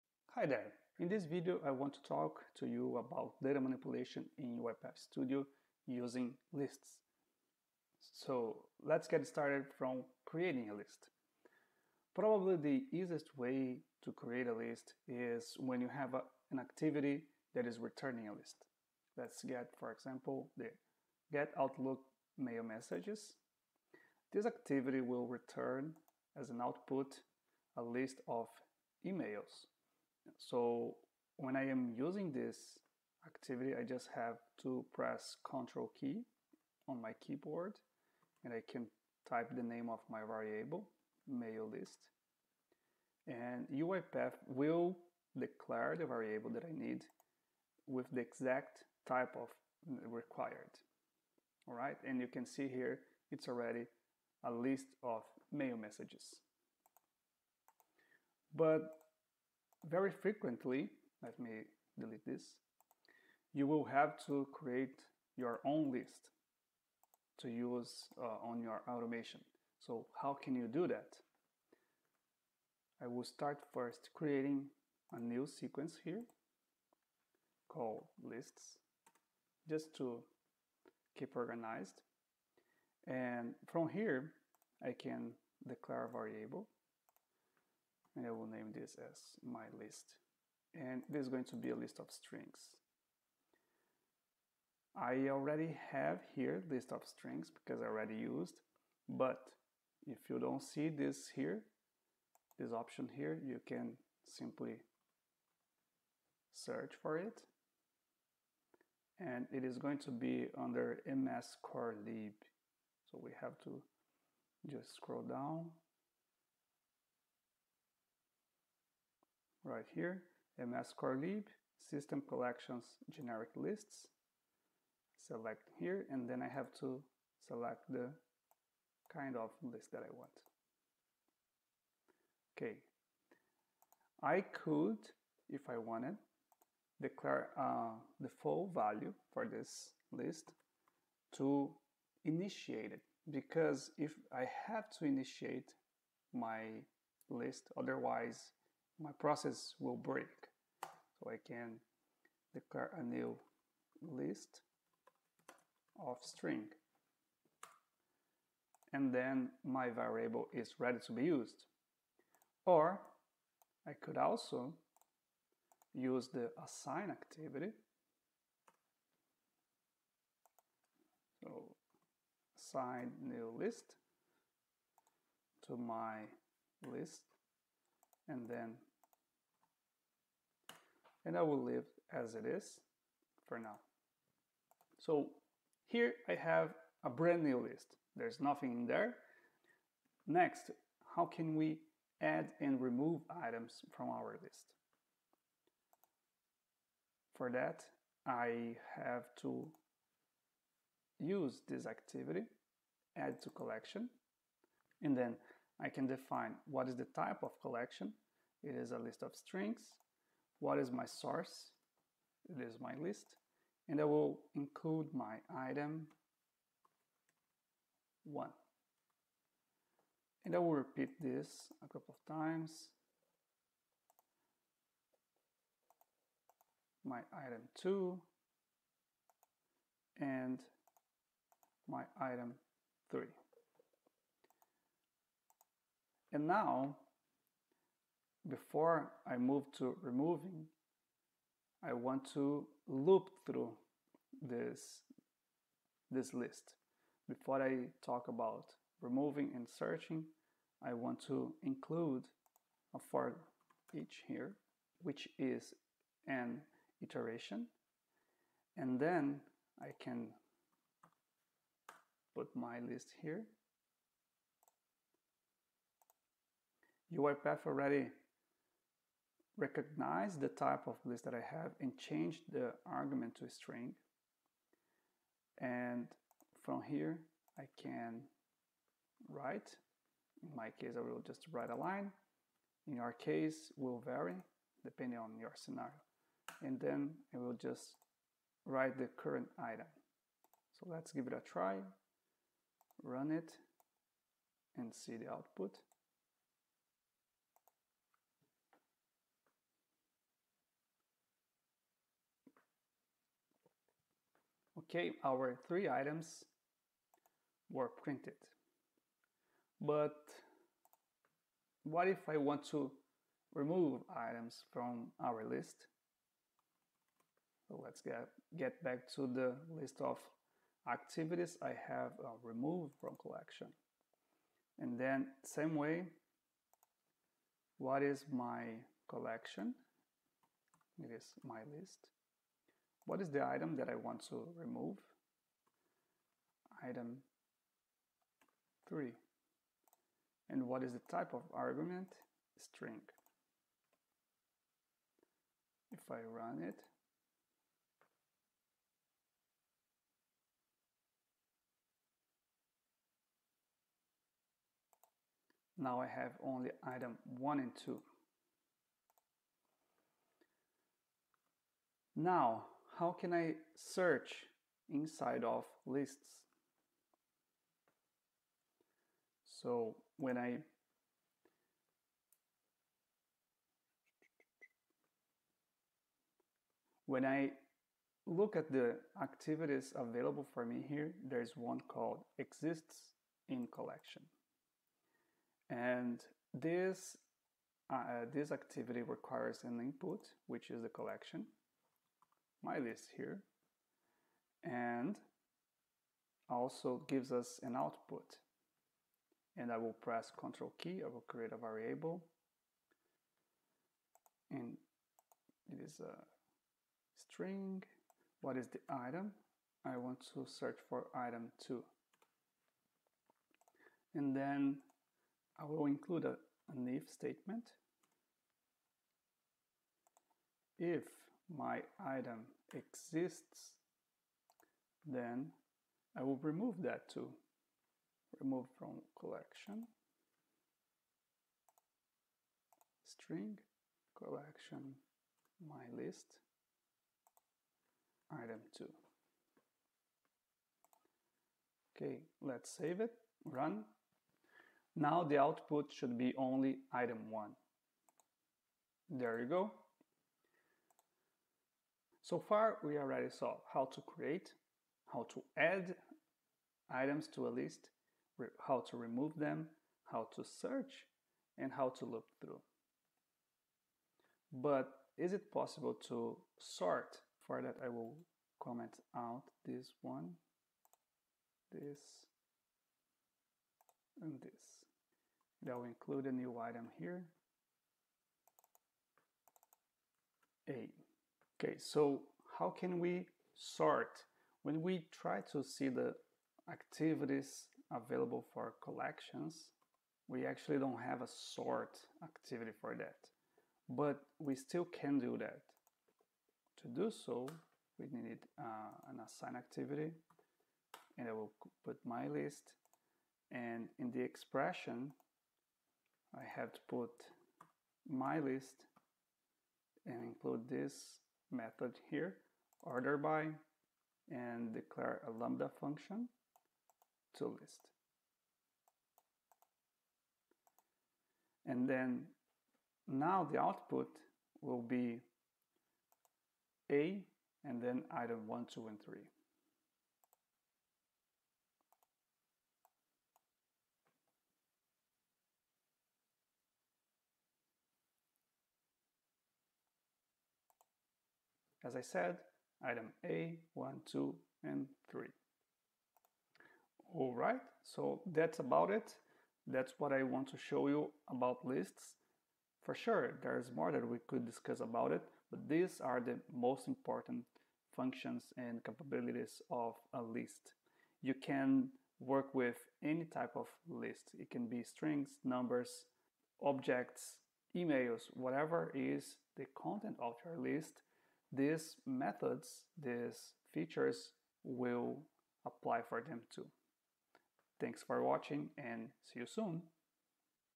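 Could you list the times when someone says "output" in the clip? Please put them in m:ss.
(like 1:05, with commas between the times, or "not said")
0:26, 4:55, 6:37, 7:25, 8:43.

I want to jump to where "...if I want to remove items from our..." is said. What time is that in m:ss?
5:12.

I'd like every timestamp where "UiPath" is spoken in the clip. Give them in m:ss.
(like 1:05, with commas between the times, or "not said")
0:04, 0:43, 4:27.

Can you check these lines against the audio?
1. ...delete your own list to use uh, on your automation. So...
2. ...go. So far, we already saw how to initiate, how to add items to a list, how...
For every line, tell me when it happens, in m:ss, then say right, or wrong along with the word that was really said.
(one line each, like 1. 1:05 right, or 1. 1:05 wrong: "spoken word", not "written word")
1. 1:04 wrong: "create", not "delete"
2. 7:29 wrong: "create", not "initiate".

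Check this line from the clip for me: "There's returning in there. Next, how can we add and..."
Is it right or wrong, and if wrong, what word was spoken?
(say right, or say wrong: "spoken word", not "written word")
wrong: "nothing", not "returning".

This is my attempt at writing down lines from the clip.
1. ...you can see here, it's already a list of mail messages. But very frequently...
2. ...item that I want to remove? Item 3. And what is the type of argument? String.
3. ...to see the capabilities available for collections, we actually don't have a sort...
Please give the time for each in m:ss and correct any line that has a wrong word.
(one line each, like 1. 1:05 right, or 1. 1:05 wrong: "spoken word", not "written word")
1. 0:52 right
2. 5:33 right
3. 8:05 wrong: "activities", not "capabilities".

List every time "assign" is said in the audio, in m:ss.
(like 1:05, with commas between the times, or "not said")
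2:46, 2:52, 8:19.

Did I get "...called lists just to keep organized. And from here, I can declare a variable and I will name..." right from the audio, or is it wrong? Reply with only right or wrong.
right.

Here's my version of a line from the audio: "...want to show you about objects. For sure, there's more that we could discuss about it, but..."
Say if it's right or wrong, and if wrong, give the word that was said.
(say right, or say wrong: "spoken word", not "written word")
wrong: "lists", not "objects".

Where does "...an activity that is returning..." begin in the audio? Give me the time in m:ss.
0:16.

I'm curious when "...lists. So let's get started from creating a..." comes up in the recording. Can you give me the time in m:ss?
0:06.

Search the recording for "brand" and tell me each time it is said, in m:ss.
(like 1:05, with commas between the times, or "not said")
3:07.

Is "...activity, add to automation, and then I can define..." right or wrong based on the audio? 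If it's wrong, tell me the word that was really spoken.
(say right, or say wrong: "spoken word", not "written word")
wrong: "collection", not "automation".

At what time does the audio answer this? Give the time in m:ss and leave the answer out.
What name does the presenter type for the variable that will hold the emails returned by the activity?
0:41.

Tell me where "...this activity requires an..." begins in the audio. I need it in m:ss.
6:28.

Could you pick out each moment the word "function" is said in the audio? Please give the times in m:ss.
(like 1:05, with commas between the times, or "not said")
8:35, 9:17.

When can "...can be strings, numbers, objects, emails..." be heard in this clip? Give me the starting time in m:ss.
9:24.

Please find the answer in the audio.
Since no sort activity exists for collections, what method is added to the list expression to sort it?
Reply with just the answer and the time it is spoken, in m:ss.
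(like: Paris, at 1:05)
Order by, at 8:32.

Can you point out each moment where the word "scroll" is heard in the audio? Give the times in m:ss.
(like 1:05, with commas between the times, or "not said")
1:54.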